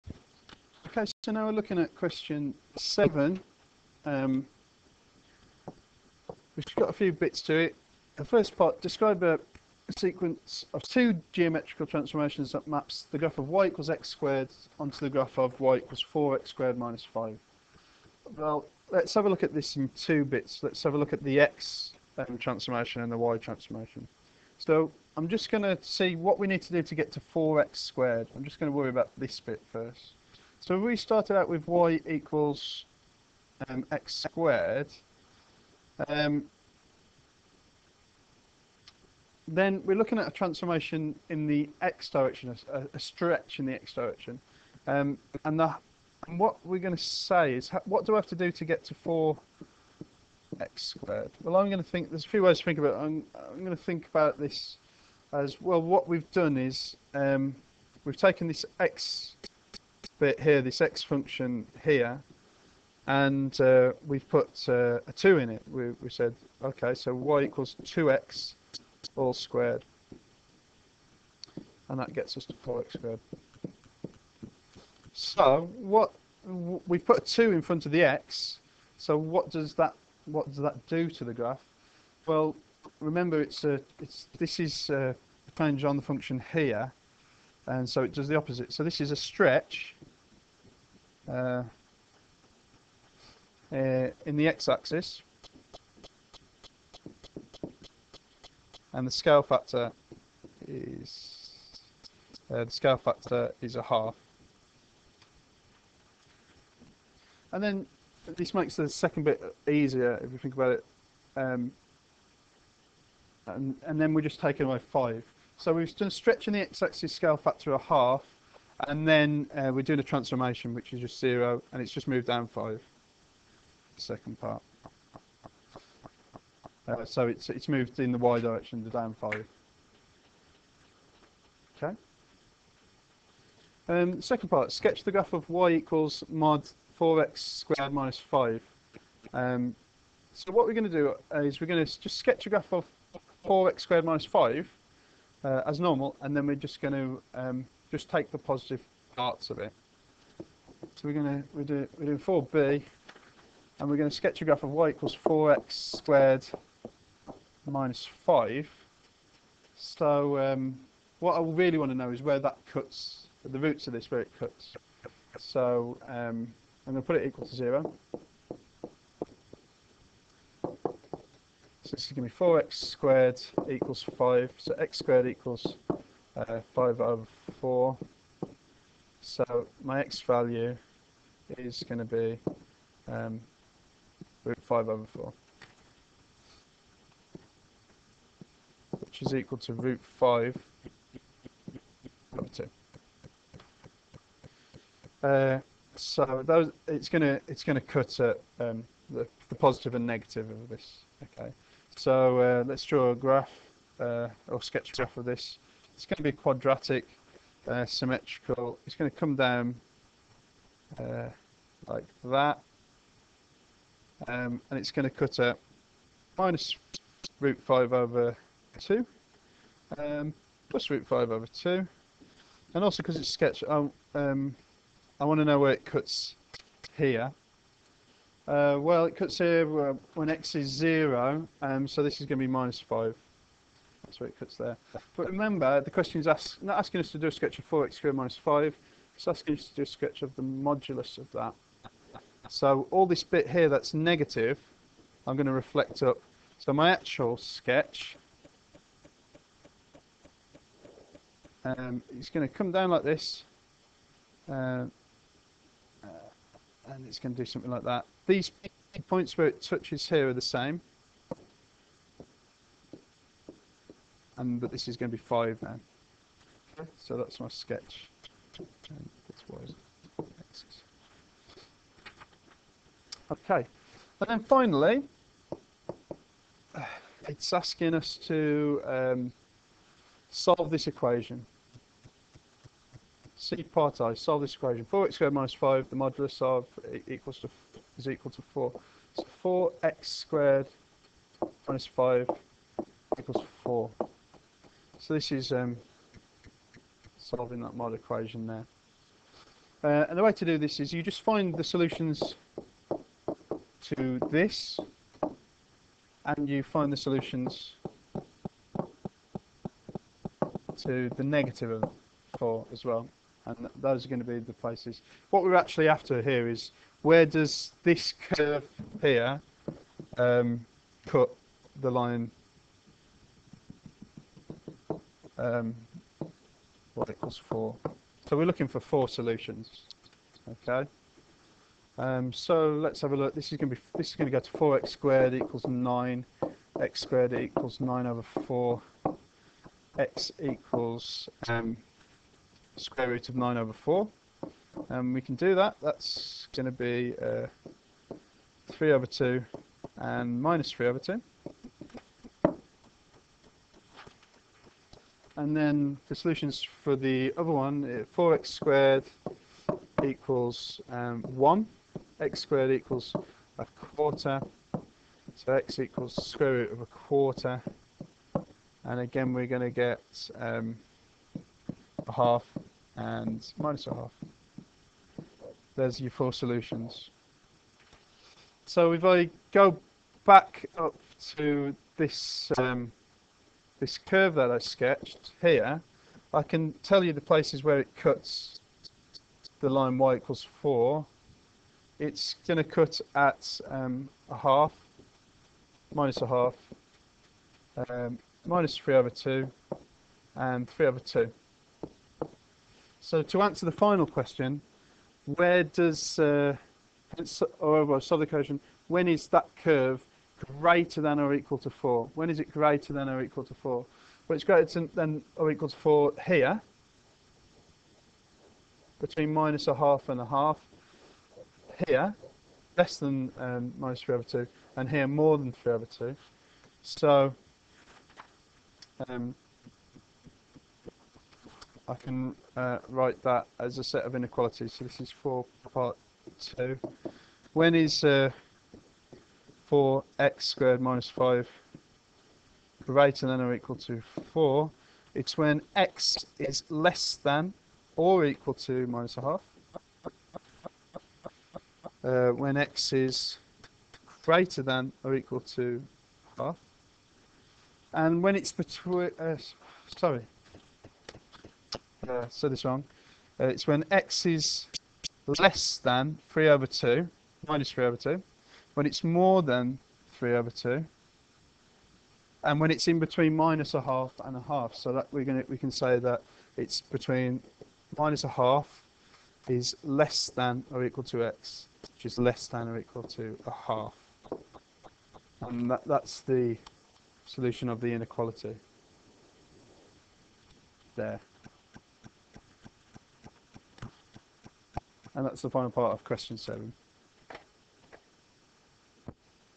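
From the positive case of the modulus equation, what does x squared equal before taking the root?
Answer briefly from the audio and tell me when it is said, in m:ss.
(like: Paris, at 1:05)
9/4, at 5:36.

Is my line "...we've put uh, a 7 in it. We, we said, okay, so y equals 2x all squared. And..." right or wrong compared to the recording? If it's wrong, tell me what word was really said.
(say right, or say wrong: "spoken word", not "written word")
wrong: "2", not "7".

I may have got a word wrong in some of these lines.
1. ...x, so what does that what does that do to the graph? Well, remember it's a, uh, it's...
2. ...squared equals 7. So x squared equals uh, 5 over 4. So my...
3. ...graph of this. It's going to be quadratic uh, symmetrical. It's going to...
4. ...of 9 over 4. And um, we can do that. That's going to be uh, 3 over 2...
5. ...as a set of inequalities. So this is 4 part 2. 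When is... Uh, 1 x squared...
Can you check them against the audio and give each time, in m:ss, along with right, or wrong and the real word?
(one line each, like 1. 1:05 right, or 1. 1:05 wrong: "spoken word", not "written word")
1. 1:18 right
2. 2:52 wrong: "5", not "7"
3. 3:24 right
4. 5:43 right
5. 7:13 wrong: "4", not "1".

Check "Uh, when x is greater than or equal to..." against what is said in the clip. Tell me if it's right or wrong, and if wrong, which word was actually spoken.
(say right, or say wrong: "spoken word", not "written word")
right.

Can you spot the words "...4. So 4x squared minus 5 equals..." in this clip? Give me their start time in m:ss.
4:48.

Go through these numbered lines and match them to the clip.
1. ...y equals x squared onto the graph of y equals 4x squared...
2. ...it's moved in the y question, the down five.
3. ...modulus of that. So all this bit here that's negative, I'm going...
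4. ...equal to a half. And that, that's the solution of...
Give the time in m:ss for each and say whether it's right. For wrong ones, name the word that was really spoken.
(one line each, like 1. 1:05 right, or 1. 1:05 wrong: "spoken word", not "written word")
1. 0:13 right
2. 2:07 wrong: "direction", not "question"
3. 4:00 right
4. 8:02 right.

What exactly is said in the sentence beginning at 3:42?
And also because it's sketch, I, um, I want to know where it cuts here.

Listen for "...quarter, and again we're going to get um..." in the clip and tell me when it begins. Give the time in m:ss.
6:06.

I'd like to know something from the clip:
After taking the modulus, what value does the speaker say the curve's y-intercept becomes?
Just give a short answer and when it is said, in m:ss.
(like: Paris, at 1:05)
5, at 4:24.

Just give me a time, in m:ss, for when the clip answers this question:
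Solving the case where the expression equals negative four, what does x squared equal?
6:02.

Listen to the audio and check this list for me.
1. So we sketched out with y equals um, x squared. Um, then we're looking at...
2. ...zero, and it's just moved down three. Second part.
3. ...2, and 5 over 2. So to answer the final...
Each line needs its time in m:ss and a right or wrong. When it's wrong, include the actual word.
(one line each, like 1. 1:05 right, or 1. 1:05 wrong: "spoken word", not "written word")
1. 0:30 wrong: "started", not "sketched"
2. 2:01 wrong: "five", not "three"
3. 6:39 wrong: "3", not "5".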